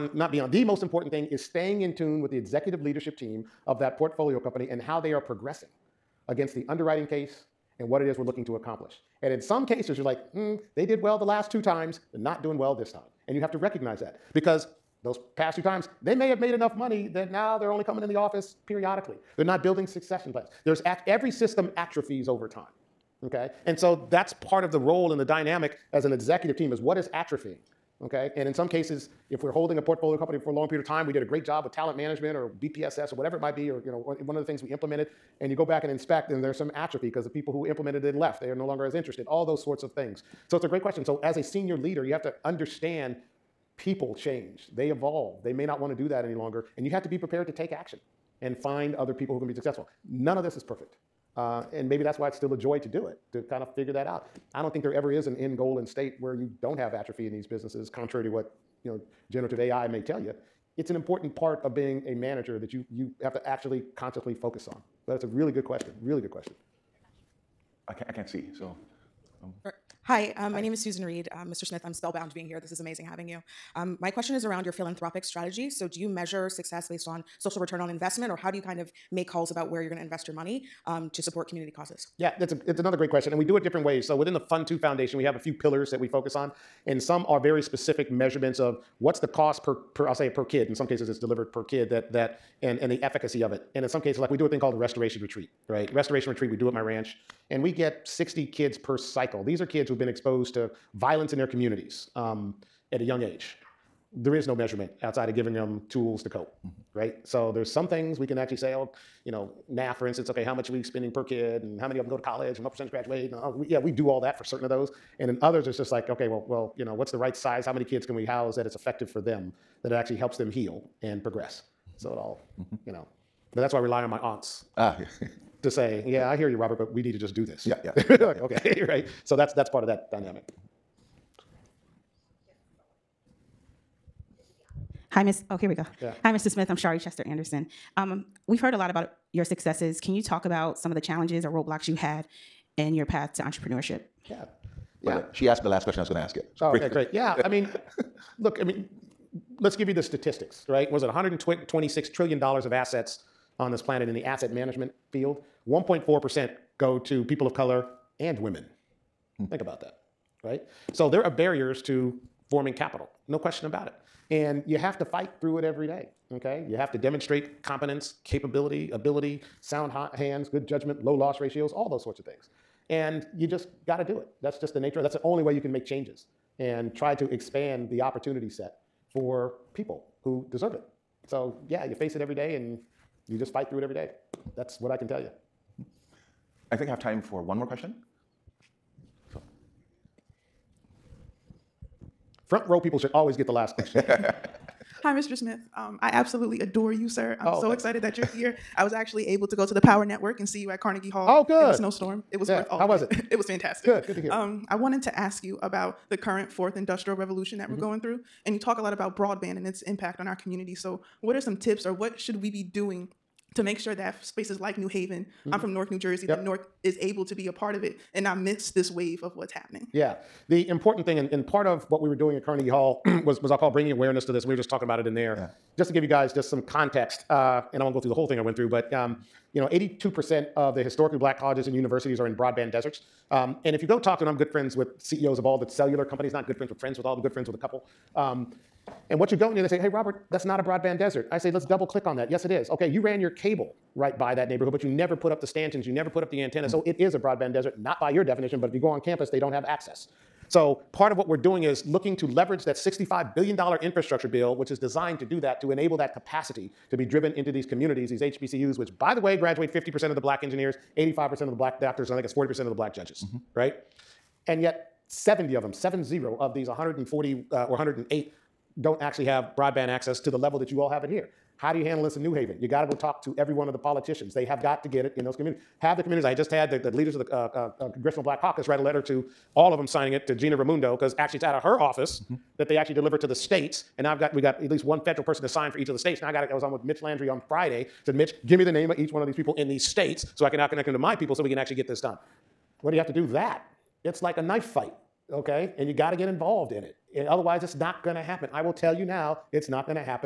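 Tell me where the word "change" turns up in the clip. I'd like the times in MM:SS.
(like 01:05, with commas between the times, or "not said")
00:44, 02:55.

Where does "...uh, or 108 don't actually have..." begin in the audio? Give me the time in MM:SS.
04:27.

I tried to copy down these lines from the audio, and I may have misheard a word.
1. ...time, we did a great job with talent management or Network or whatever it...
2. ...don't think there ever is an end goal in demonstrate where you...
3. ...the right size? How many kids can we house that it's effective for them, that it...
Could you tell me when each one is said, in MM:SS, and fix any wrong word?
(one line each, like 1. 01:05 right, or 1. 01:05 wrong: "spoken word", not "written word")
1. 00:30 wrong: "BPSS", not "Network"
2. 00:54 wrong: "state", not "demonstrate"
3. 01:57 right.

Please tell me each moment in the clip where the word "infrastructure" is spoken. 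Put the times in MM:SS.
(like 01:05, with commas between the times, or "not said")
04:13.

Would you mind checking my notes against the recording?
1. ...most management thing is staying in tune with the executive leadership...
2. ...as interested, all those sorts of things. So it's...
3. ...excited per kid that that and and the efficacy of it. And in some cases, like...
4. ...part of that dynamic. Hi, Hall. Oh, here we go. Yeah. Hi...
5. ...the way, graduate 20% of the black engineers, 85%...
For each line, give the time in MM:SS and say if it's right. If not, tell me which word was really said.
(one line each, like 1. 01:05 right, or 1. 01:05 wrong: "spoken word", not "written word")
1. 00:00 wrong: "important", not "management"
2. 00:38 right
3. 01:31 wrong: "delivered", not "excited"
4. 02:09 wrong: "Miss", not "Hall"
5. 04:19 wrong: "50", not "20".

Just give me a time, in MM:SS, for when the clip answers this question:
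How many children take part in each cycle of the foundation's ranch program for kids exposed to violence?
01:38.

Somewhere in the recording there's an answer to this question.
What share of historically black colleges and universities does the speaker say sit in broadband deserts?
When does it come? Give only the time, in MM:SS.
03:49.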